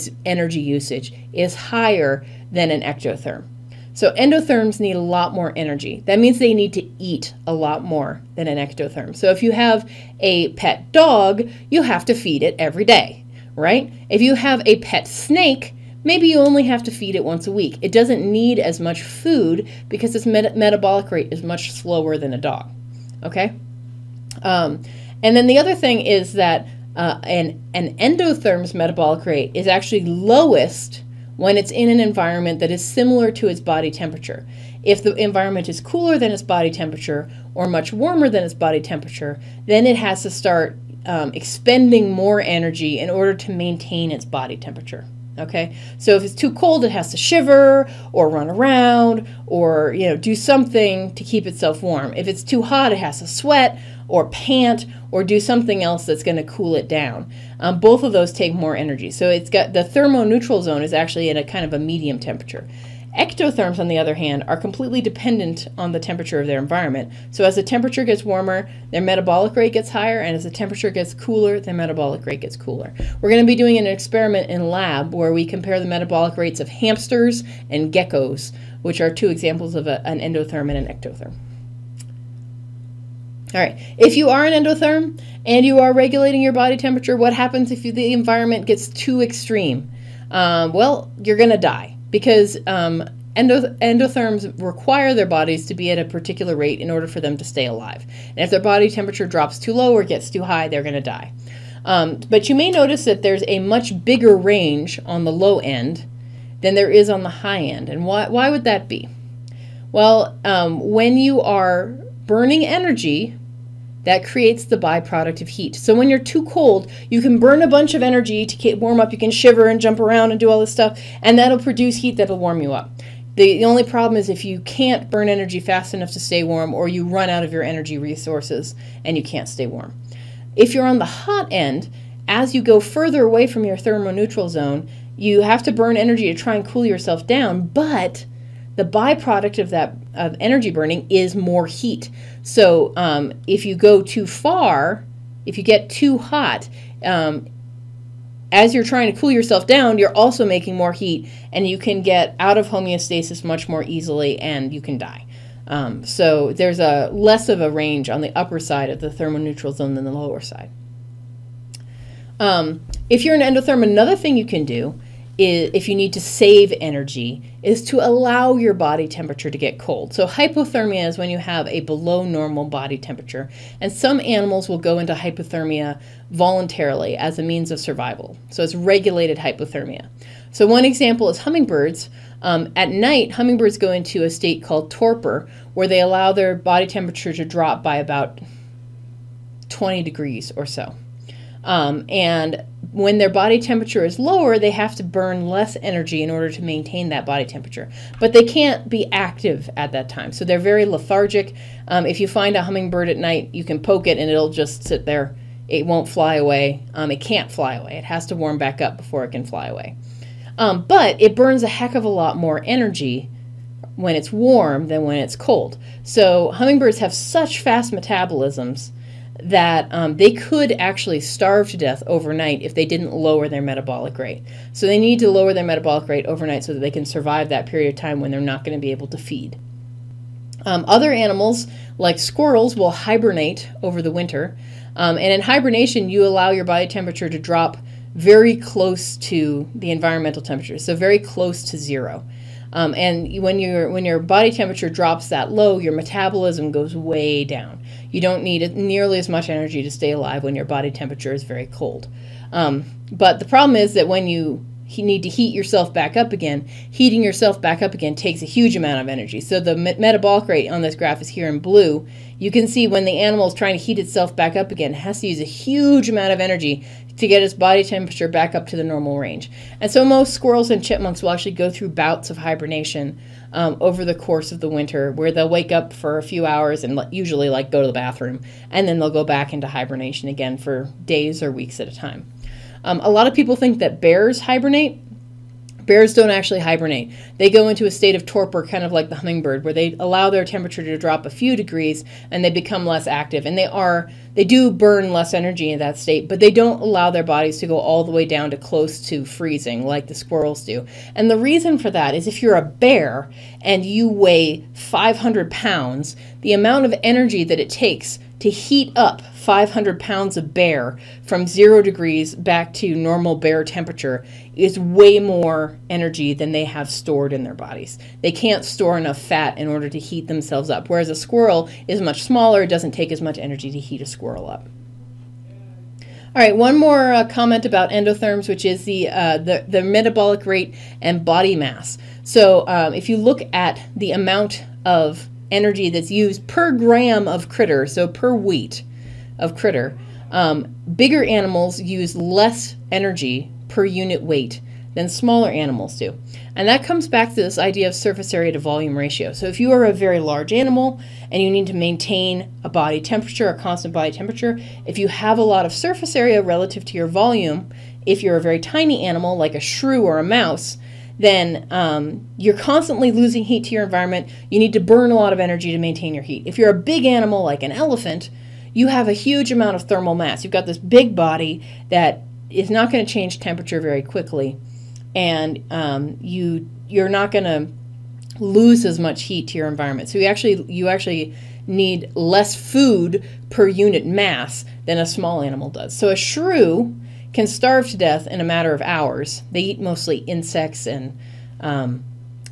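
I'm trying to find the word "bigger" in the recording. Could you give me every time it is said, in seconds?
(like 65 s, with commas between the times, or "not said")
104 s, 340 s.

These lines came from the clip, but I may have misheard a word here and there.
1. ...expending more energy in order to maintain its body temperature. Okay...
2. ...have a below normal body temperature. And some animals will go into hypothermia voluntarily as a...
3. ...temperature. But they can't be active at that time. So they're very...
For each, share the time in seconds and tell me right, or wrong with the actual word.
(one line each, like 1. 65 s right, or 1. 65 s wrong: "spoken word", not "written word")
1. 41 s right
2. 171 s right
3. 197 s right.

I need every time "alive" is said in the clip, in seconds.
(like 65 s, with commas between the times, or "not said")
97 s, 250 s.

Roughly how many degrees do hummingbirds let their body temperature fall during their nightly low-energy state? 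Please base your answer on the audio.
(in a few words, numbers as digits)
about 20 degrees.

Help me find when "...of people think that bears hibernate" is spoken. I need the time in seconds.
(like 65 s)
283 s.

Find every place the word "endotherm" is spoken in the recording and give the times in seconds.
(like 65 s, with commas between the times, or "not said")
4 s, 27 s, 80 s, 84 s, 93 s, 163 s, 327 s.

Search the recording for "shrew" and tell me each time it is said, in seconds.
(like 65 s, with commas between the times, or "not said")
359 s, 386 s.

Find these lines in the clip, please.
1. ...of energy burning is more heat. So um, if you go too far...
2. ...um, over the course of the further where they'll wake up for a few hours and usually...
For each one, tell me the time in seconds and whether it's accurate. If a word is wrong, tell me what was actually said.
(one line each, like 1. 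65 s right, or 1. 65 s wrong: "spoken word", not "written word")
1. 140 s right
2. 273 s wrong: "winter", not "further".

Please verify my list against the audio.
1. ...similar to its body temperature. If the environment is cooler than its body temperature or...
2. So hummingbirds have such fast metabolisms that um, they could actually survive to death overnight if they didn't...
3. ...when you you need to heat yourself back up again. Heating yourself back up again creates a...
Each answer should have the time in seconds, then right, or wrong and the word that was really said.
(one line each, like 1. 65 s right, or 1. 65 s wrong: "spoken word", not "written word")
1. 32 s right
2. 216 s wrong: "starve", not "survive"
3. 254 s wrong: "takes", not "creates".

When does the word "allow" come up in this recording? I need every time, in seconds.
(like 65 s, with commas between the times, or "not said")
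168 s, 185 s, 236 s, 289 s, 296 s.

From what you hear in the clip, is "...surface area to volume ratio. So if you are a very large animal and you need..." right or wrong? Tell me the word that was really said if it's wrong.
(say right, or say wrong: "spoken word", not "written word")
right.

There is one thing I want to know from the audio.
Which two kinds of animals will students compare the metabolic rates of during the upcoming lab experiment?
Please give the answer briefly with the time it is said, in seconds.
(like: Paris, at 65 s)
hamsters and geckos, at 76 s.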